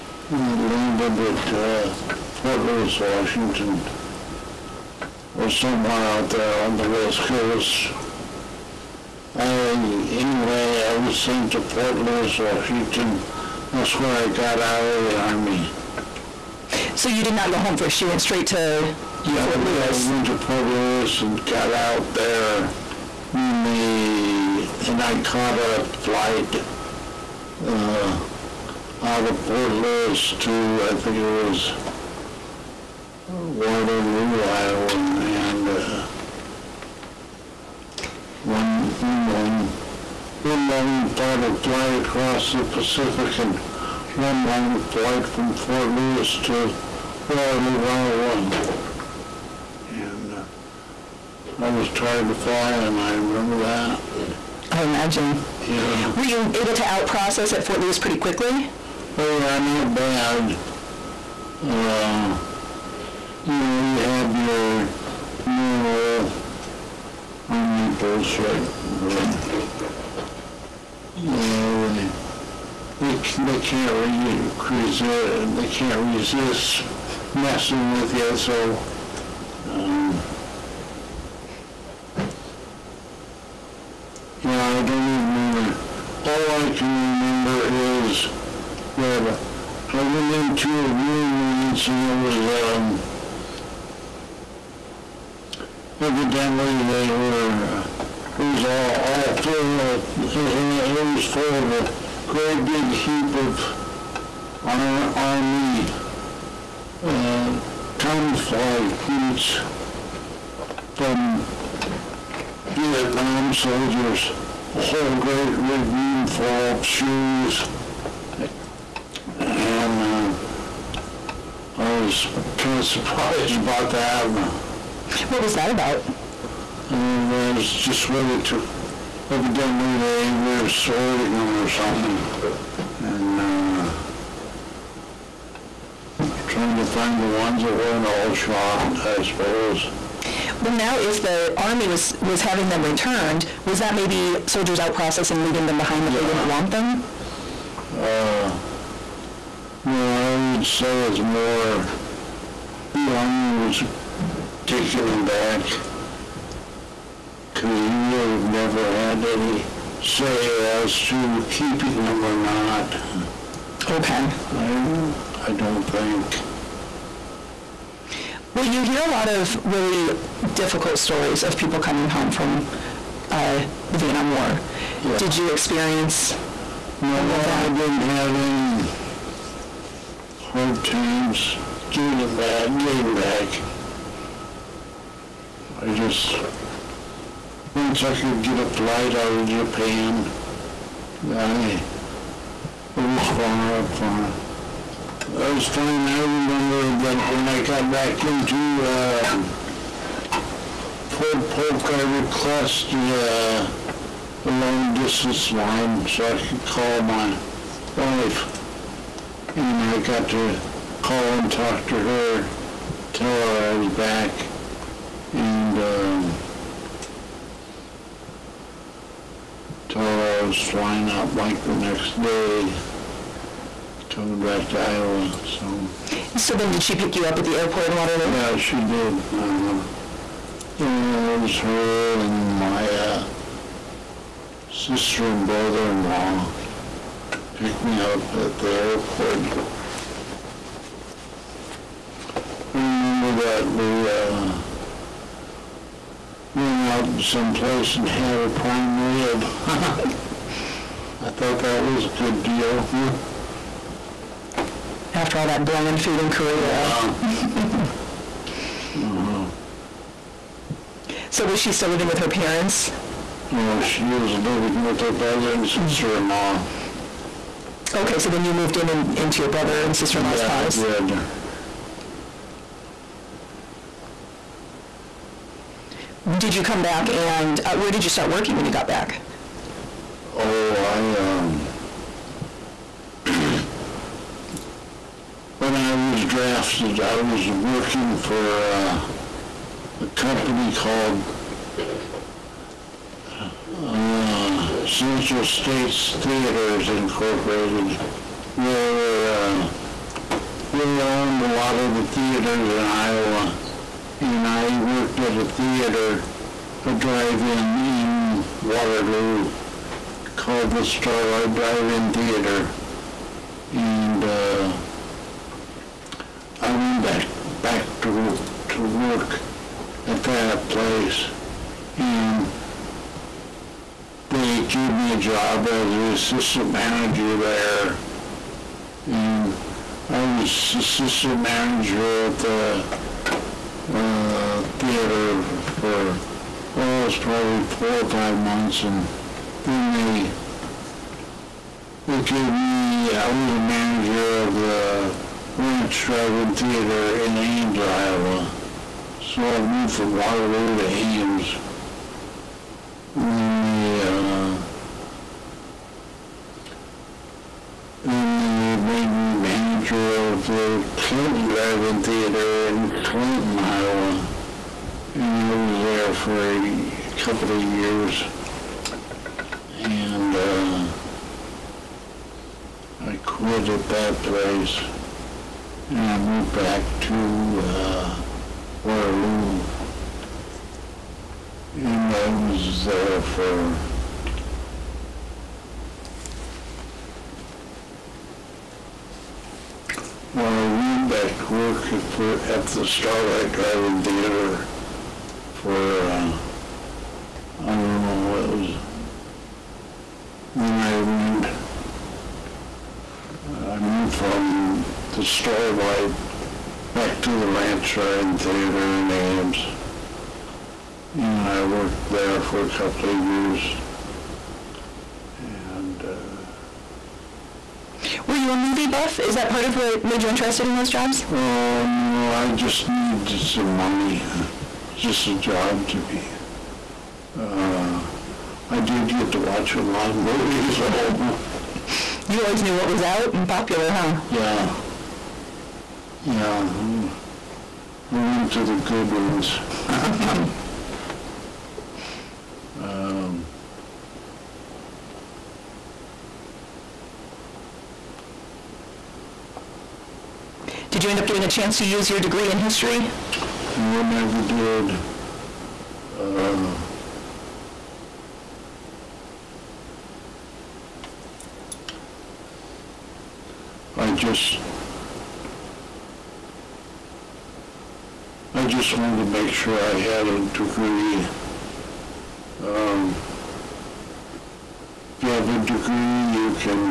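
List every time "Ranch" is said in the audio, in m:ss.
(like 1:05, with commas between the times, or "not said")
5:45, 6:47.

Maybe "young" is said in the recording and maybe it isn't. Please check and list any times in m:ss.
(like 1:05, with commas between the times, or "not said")
not said.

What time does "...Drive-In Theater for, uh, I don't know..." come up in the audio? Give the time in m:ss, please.
6:33.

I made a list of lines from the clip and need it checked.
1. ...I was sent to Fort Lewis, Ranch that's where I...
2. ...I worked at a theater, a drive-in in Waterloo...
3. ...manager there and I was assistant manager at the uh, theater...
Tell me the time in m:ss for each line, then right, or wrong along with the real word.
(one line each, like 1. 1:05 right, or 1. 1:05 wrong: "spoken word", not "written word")
1. 0:10 wrong: "Washington", not "Ranch"
2. 5:04 right
3. 5:26 right.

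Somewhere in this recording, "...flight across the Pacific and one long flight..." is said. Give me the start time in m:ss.
0:41.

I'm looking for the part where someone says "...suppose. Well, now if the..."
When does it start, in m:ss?
2:19.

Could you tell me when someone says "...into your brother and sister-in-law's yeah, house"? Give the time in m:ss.
4:29.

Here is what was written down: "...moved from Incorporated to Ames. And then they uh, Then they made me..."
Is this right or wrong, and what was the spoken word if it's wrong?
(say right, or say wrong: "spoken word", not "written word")
wrong: "Waterloo", not "Incorporated".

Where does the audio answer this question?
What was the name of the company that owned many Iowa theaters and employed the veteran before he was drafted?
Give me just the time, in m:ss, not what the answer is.
4:54.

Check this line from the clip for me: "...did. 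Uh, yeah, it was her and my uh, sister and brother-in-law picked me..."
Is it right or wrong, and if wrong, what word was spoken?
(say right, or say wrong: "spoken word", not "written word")
right.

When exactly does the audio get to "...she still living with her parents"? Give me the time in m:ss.
4:21.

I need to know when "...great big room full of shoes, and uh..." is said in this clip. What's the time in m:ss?
1:55.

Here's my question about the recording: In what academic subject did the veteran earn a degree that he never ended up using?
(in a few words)
history.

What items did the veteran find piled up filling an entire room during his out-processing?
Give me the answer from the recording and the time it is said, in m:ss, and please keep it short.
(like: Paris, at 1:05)
camouflage boots, at 1:47.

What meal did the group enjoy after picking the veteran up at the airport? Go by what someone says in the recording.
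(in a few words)
prime rib.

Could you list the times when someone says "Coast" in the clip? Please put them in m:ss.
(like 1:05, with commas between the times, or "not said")
0:07.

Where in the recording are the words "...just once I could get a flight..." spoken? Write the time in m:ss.
3:05.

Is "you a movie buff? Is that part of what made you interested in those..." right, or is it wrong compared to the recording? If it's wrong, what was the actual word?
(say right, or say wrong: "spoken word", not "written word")
right.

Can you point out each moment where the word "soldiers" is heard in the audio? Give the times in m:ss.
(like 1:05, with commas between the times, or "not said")
1:53, 2:24.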